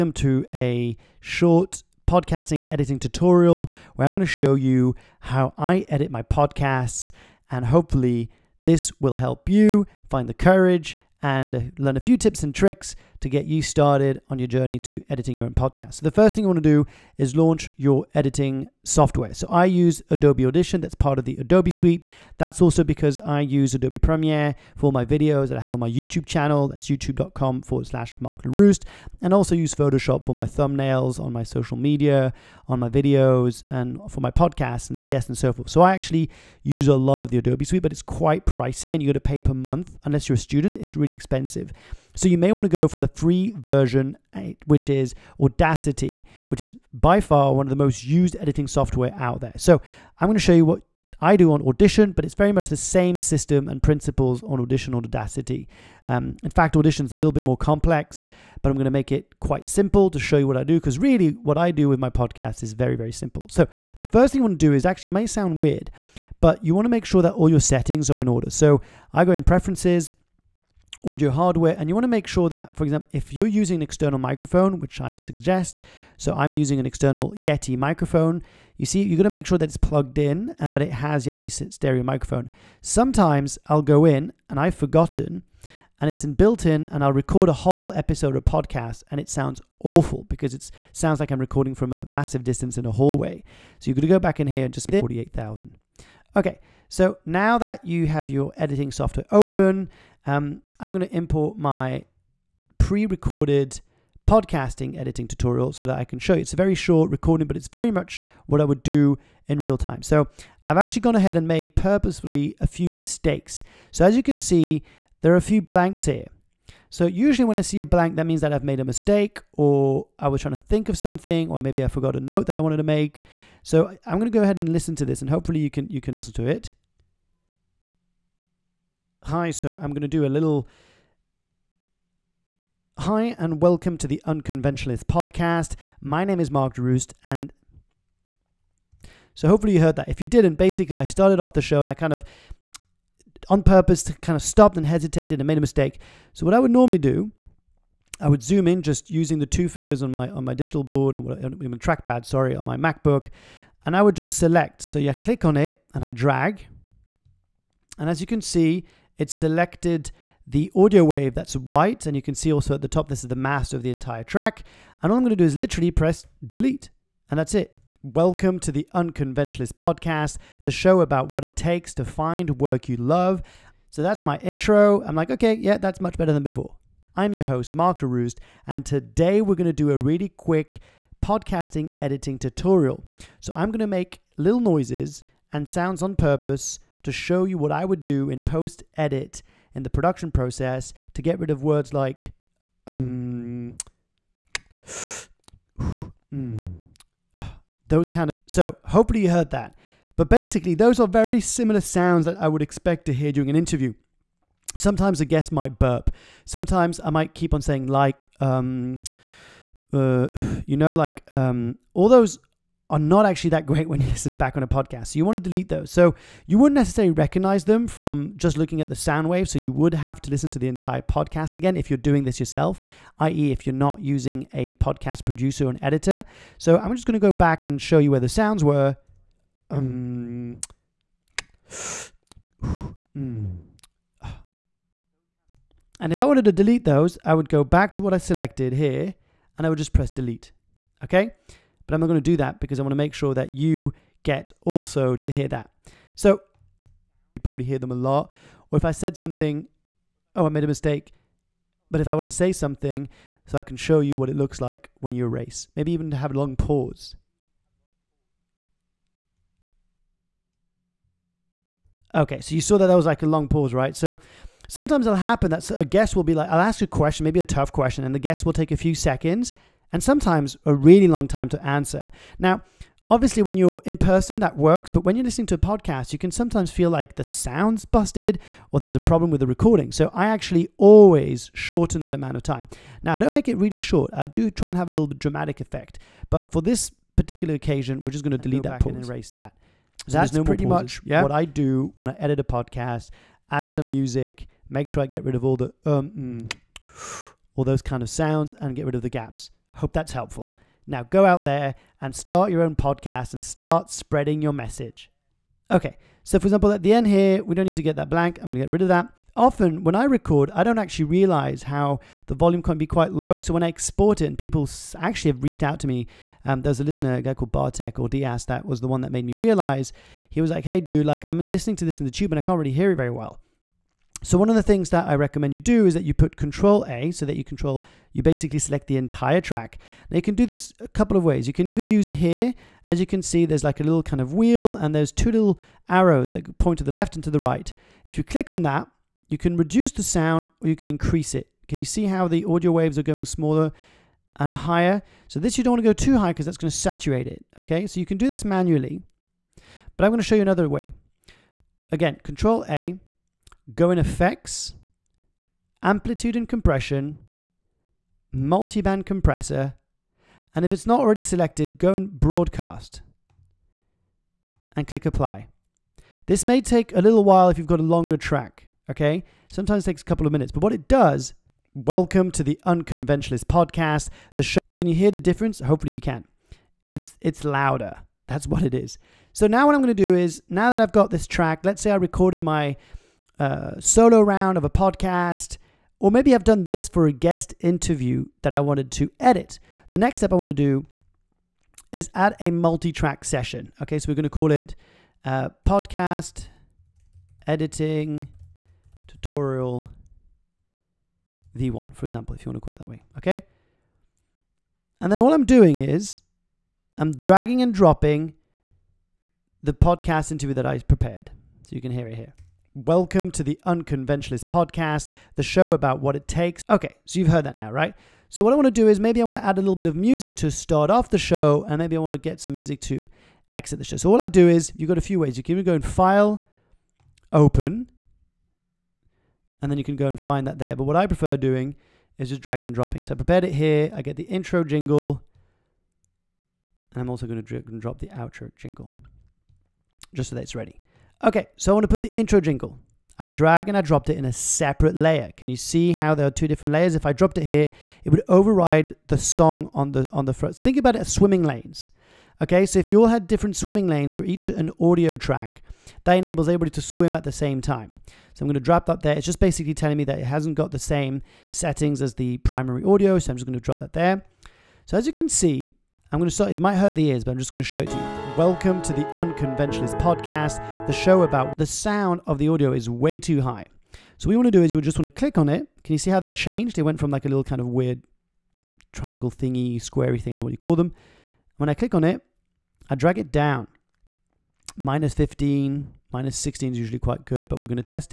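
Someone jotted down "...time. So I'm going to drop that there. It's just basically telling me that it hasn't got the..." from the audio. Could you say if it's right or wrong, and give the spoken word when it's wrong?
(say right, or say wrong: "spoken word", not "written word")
right.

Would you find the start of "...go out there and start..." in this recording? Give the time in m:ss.
5:01.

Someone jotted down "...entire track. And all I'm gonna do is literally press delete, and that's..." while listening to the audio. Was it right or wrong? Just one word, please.
right.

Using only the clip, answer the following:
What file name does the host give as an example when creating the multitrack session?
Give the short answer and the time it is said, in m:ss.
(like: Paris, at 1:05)
Podcast editing tutorial V1, at 6:35.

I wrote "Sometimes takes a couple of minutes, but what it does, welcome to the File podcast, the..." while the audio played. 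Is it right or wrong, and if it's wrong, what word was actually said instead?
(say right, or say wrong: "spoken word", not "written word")
wrong: "Unconventionalist", not "File".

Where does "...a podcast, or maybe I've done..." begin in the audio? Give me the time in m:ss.
6:24.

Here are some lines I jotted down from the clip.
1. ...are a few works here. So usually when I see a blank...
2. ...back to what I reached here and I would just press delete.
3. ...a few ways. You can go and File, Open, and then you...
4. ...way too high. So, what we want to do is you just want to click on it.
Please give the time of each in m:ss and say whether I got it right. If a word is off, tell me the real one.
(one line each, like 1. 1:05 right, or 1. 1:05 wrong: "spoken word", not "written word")
1. 1:55 wrong: "blanks", not "works"
2. 3:57 wrong: "selected", not "reached"
3. 7:04 right
4. 7:52 right.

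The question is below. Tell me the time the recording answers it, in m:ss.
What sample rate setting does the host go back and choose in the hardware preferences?
1:34.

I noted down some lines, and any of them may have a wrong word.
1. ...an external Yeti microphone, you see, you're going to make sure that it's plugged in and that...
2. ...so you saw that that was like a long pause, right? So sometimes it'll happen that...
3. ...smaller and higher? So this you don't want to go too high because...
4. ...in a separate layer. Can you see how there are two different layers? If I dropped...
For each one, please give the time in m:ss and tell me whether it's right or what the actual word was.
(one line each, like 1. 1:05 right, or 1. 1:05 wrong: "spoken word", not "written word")
1. 1:16 right
2. 4:22 right
3. 5:43 right
4. 7:24 right.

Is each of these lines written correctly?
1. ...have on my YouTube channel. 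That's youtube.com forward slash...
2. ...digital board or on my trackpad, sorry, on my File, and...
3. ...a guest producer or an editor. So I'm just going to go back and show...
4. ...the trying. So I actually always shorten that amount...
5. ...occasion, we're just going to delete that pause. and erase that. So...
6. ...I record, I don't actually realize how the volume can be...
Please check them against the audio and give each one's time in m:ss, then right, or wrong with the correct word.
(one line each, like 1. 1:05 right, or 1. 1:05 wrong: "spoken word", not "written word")
1. 0:25 right
2. 2:30 wrong: "MacBook", not "File"
3. 3:44 wrong: "podcast", not "guest"
4. 4:39 wrong: "recording", not "trying"
5. 4:47 right
6. 5:09 right.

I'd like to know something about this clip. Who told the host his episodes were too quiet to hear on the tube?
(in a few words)
Bartek.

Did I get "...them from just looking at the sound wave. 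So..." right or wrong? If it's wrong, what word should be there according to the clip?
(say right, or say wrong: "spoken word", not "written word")
right.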